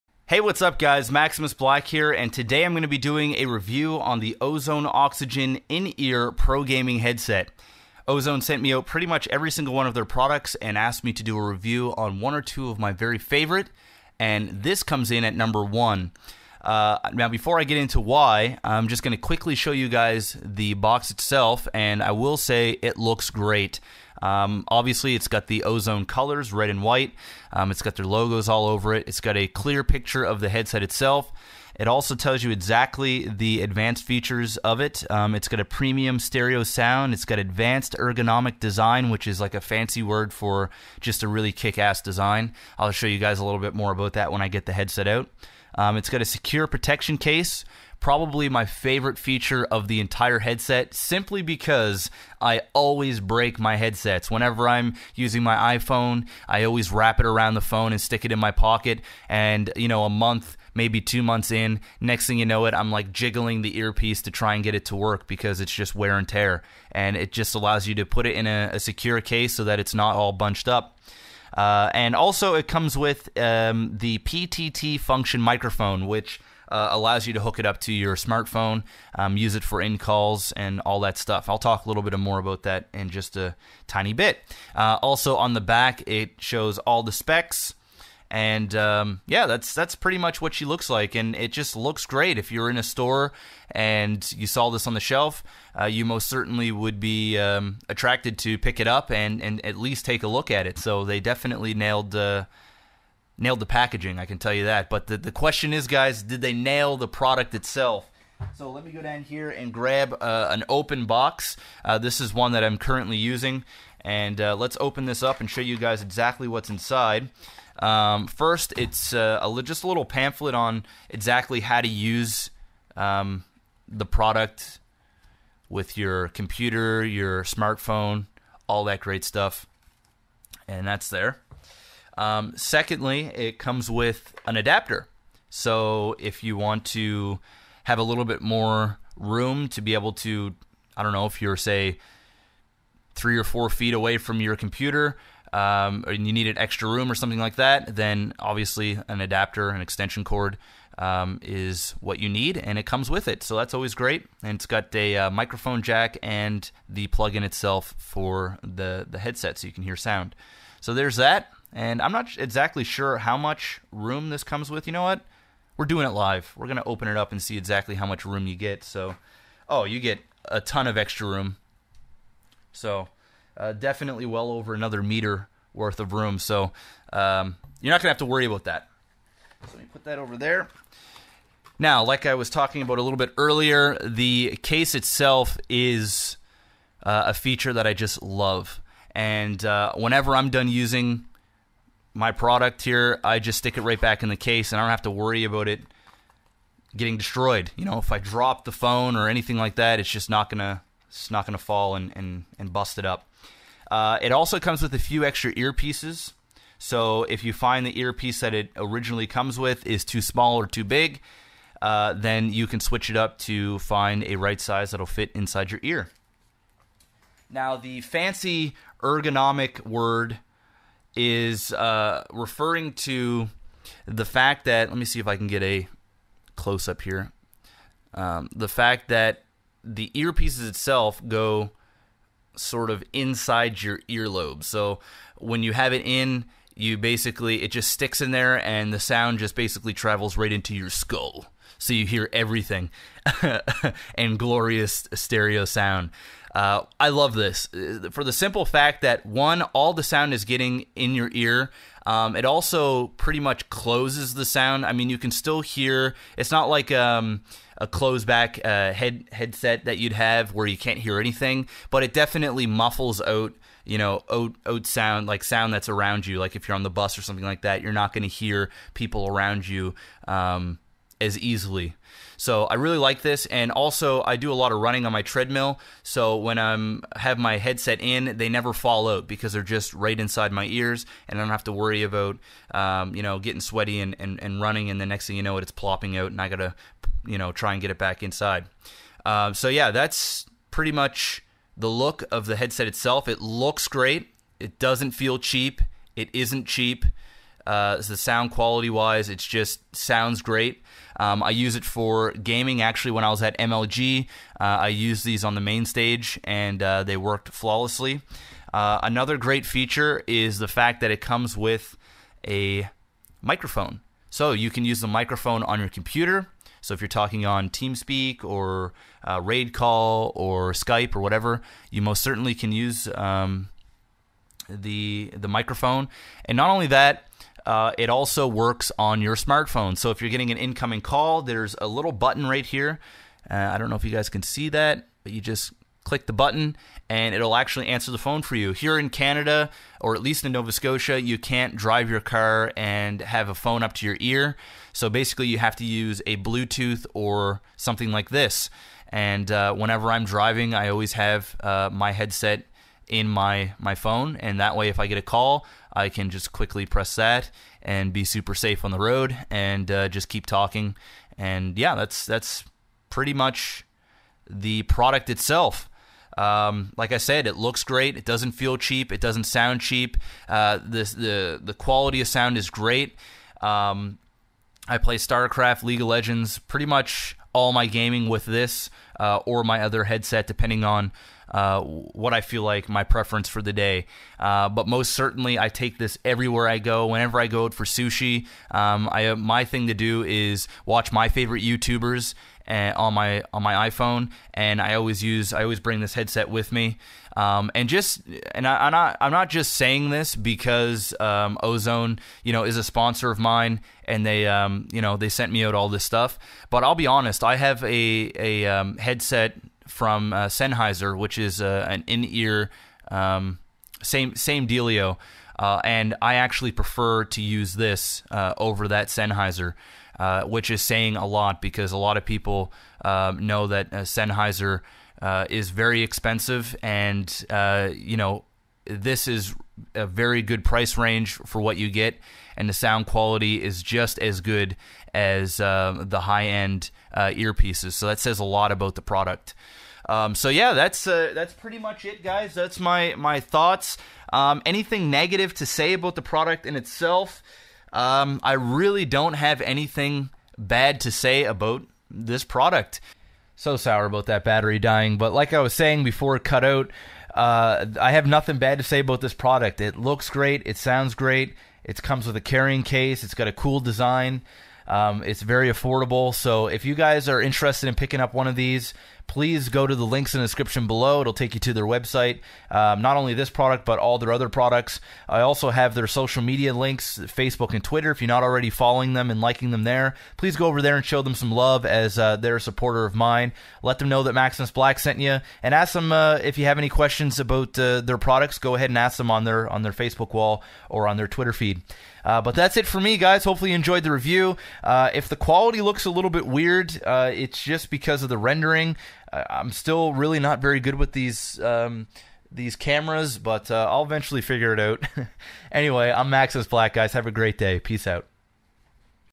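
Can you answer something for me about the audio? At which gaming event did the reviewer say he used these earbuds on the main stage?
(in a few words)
MLG.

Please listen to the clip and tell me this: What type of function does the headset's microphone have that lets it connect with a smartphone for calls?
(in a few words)
PTT.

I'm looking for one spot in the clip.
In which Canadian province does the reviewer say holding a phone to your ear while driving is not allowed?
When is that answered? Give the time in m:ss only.
5:40.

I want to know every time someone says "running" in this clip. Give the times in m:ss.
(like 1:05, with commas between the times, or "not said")
4:34, 4:44.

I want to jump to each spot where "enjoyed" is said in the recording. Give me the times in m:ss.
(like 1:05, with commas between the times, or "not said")
8:13.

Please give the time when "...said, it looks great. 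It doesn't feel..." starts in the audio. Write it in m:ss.
6:07.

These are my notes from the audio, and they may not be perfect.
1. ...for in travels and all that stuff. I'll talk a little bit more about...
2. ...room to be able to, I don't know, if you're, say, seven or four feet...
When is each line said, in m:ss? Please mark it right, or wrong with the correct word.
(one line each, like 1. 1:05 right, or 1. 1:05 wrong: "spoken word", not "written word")
1. 1:19 wrong: "calls", not "travels"
2. 2:19 wrong: "three", not "seven".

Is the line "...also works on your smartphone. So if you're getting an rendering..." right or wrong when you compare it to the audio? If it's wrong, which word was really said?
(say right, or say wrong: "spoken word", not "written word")
wrong: "incoming", not "rendering".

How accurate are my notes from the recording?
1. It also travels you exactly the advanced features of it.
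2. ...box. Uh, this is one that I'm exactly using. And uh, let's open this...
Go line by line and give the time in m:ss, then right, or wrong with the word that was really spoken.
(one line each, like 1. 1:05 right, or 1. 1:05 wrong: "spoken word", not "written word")
1. 0:31 wrong: "tells", not "travels"
2. 1:51 wrong: "currently", not "exactly".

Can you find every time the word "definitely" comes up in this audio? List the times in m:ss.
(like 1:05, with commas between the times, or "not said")
1:41, 2:53, 4:22.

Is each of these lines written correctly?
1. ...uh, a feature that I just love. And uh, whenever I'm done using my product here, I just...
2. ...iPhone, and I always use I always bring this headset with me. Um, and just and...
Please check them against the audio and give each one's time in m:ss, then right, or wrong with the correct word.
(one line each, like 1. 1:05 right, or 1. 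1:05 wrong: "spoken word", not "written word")
1. 3:07 right
2. 6:33 right.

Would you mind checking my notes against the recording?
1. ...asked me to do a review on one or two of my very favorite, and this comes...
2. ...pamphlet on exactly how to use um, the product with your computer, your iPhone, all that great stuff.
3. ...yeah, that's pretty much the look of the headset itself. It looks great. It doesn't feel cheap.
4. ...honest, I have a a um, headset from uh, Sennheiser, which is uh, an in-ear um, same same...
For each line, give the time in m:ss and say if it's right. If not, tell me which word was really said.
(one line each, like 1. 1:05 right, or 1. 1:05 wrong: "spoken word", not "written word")
1. 0:10 right
2. 2:00 wrong: "smartphone", not "iPhone"
3. 4:49 right
4. 6:47 right.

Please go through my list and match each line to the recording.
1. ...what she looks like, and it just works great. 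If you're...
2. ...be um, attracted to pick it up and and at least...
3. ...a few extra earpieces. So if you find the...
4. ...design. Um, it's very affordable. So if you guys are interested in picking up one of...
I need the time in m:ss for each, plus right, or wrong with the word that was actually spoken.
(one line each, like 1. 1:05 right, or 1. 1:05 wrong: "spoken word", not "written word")
1. 1:30 wrong: "looks", not "works"
2. 1:37 right
3. 3:24 right
4. 7:43 right.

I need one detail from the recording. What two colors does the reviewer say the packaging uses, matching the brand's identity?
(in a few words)
red and white.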